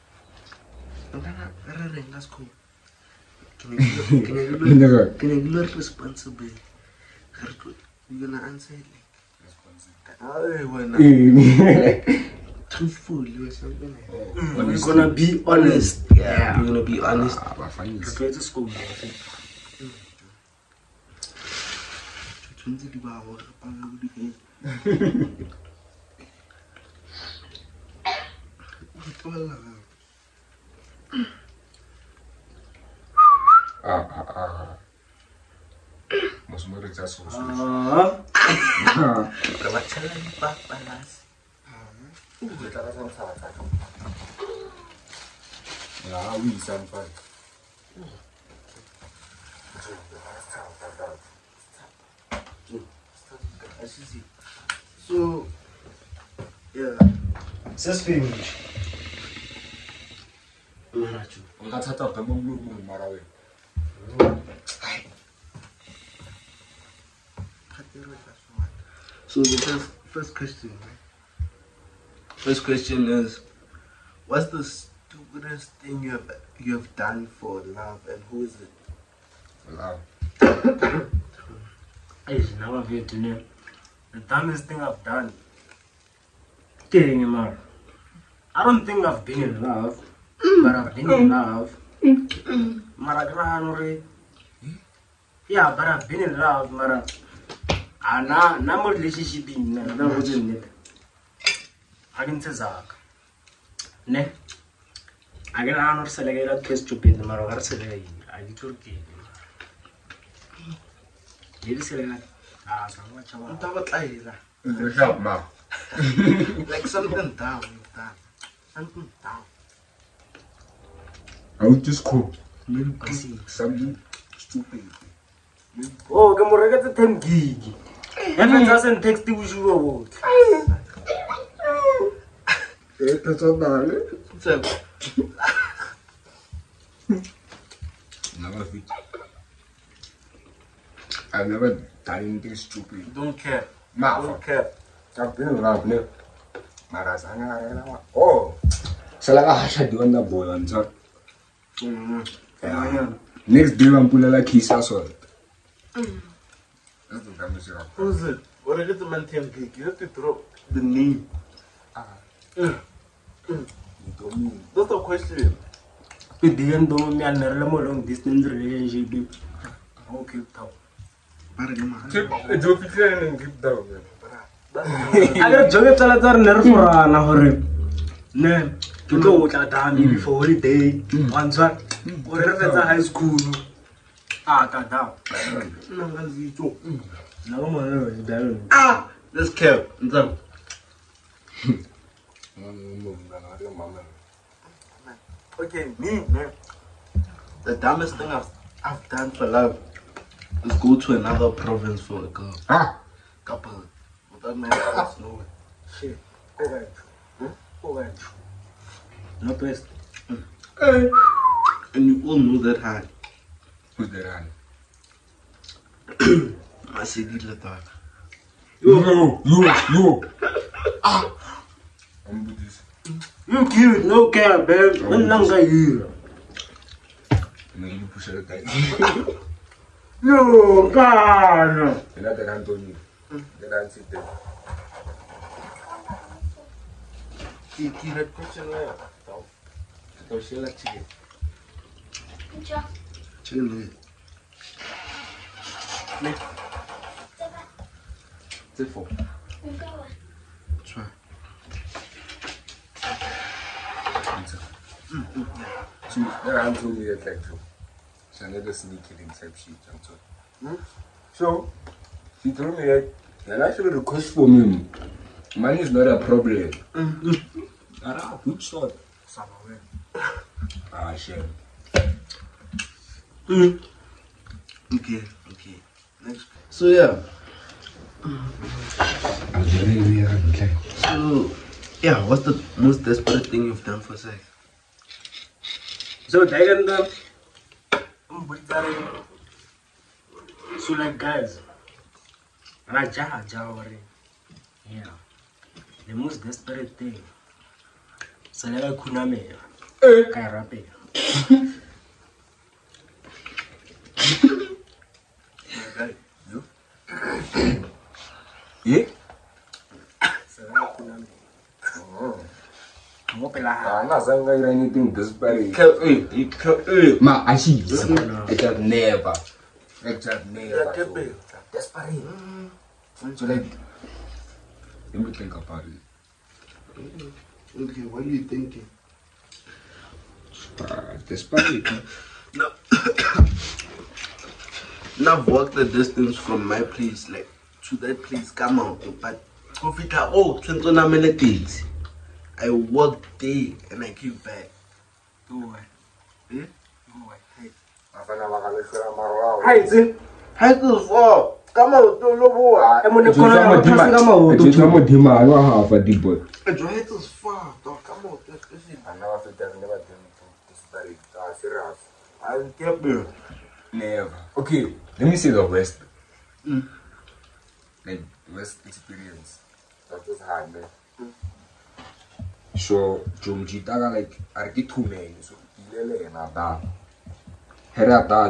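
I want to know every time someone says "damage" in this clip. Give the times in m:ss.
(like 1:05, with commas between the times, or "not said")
2:37.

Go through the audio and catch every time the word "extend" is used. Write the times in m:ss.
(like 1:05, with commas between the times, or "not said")
not said.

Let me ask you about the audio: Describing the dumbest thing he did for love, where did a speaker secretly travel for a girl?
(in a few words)
another province.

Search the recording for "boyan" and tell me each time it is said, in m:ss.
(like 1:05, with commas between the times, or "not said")
2:30.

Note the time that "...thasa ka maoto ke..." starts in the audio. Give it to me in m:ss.
5:53.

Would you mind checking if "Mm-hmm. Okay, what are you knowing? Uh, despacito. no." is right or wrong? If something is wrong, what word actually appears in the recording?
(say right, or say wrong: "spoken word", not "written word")
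wrong: "thinking", not "knowing".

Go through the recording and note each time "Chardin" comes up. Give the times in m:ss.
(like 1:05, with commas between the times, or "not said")
not said.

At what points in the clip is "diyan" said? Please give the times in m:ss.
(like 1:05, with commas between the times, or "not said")
2:46.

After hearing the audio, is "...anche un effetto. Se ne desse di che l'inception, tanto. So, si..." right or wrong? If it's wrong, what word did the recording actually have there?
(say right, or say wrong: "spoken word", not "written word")
right.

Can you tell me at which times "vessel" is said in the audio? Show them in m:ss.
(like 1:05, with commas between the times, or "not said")
not said.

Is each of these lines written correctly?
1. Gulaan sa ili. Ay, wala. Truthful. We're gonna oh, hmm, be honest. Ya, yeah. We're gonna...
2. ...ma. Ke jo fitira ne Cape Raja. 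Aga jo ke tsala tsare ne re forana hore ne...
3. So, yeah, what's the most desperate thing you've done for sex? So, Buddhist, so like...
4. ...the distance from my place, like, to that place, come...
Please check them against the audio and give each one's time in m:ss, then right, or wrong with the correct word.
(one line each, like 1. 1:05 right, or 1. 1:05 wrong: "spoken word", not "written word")
1. 0:08 right
2. 2:51 wrong: "Town", not "Raja"
3. 4:39 wrong: "Daganda", not "Buddhist"
4. 5:35 right.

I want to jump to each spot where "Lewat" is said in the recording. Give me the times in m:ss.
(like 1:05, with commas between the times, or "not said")
0:37.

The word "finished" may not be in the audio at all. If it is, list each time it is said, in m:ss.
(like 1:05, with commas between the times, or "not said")
0:58.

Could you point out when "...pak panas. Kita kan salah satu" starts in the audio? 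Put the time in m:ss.
0:40.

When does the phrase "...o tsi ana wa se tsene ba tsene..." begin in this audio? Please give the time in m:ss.
5:58.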